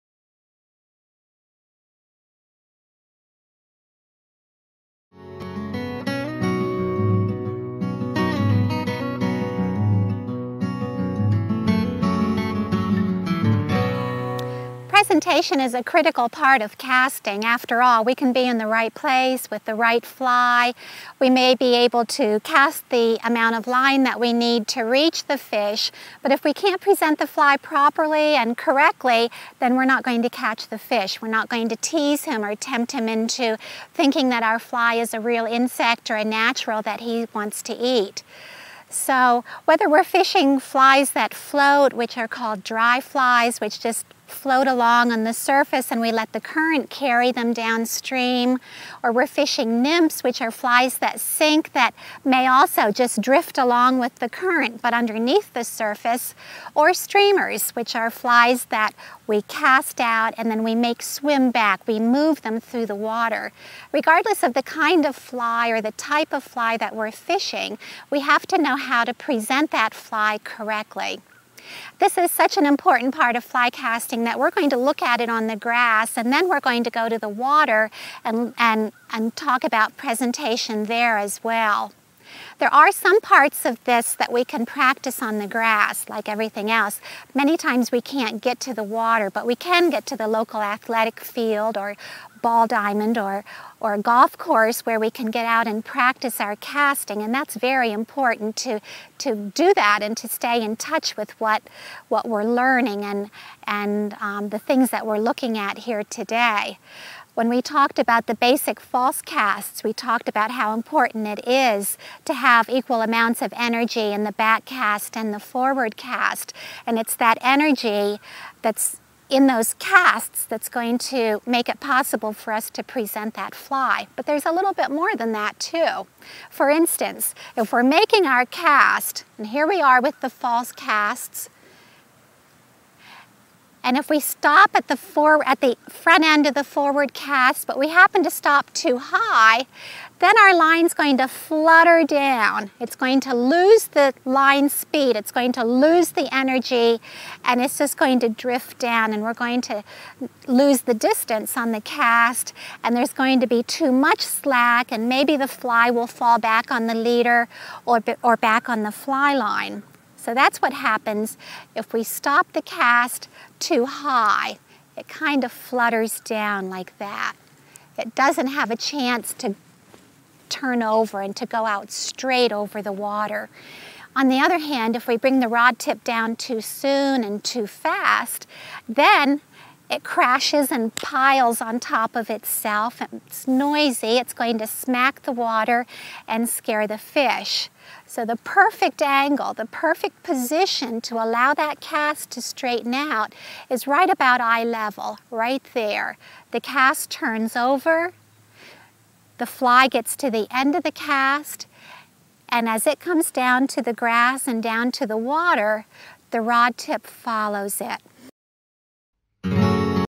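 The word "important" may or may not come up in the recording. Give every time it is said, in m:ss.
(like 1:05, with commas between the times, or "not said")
1:12, 1:37, 1:50.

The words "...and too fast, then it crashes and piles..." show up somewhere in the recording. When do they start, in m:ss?
2:57.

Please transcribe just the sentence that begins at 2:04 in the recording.
But there's a little bit more than that too.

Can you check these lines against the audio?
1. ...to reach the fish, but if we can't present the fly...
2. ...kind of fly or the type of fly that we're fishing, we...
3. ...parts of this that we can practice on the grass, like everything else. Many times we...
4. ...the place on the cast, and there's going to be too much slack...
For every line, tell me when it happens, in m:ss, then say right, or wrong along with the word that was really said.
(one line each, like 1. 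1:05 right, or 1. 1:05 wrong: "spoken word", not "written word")
1. 0:24 right
2. 1:04 right
3. 1:23 right
4. 2:30 wrong: "distance", not "place".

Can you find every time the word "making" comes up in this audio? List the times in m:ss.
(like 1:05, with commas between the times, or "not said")
2:07.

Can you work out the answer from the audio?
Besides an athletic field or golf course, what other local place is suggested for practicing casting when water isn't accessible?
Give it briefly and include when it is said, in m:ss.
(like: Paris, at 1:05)
Ball diamond, at 1:32.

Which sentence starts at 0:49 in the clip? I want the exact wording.
Or we're fishing nymphs, which are flies that sink that may also just drift along with the current but underneath the surface.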